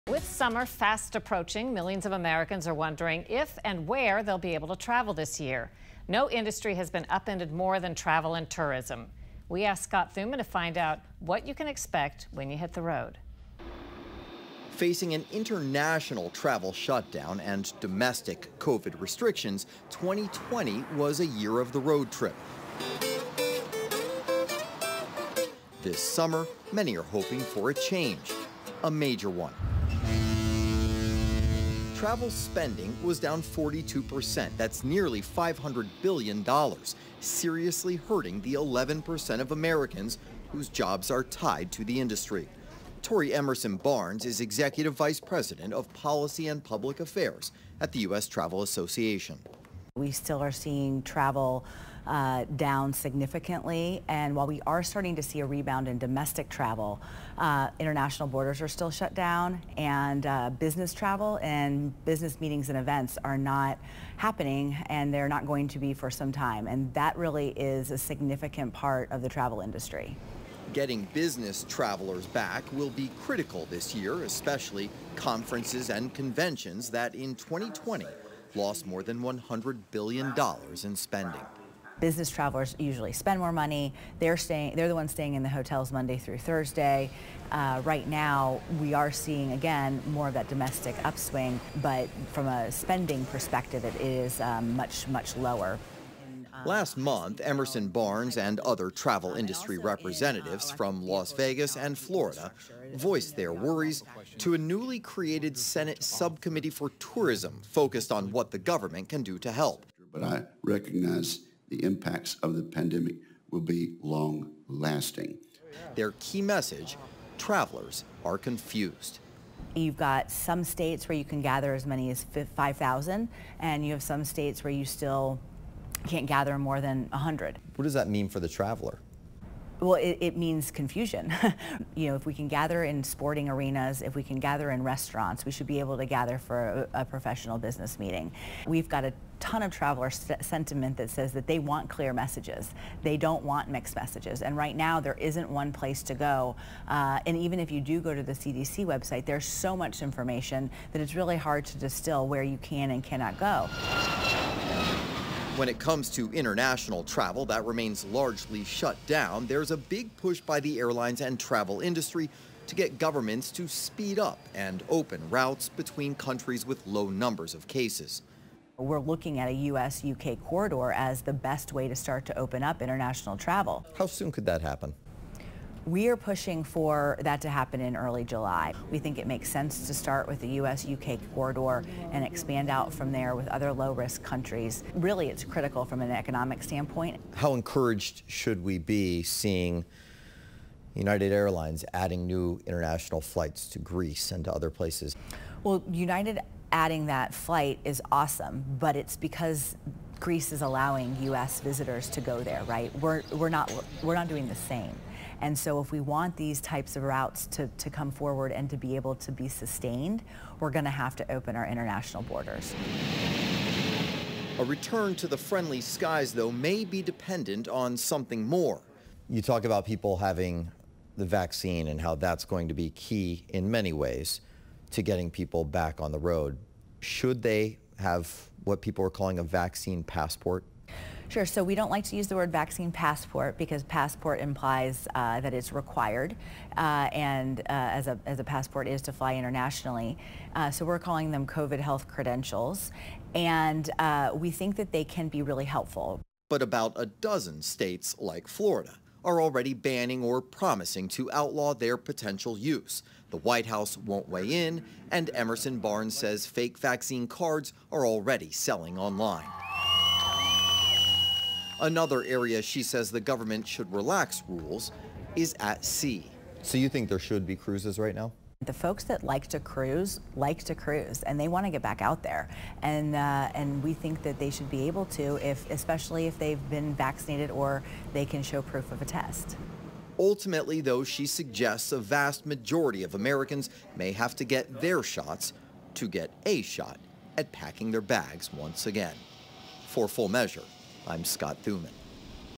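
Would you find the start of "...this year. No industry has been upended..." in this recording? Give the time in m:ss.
0:05.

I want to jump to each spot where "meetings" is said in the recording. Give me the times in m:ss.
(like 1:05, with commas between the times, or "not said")
1:02, 2:17.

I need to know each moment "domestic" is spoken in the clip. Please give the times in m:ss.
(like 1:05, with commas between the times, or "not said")
0:17, 0:55, 1:30.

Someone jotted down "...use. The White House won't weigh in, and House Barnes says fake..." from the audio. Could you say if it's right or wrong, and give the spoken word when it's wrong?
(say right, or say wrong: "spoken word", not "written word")
wrong: "Emerson", not "House".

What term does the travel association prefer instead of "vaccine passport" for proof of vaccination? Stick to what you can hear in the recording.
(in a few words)
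COVID health credentials.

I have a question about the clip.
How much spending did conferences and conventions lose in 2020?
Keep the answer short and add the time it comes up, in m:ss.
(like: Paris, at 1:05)
more than $100 billion, at 1:18.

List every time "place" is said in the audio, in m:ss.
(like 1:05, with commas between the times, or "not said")
2:25, 3:14.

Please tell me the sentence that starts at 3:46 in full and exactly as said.
Should they have what people are calling a vaccine passport Sure.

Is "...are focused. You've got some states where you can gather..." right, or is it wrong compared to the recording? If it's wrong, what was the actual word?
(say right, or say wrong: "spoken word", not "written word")
wrong: "confused", not "focused".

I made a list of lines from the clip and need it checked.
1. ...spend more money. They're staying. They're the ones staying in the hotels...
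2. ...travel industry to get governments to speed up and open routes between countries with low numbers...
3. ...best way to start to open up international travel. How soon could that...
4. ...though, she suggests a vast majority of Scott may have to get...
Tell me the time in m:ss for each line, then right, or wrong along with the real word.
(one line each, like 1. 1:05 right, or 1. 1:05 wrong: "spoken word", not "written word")
1. 1:23 right
2. 2:41 right
3. 2:51 right
4. 4:40 wrong: "Americans", not "Scott".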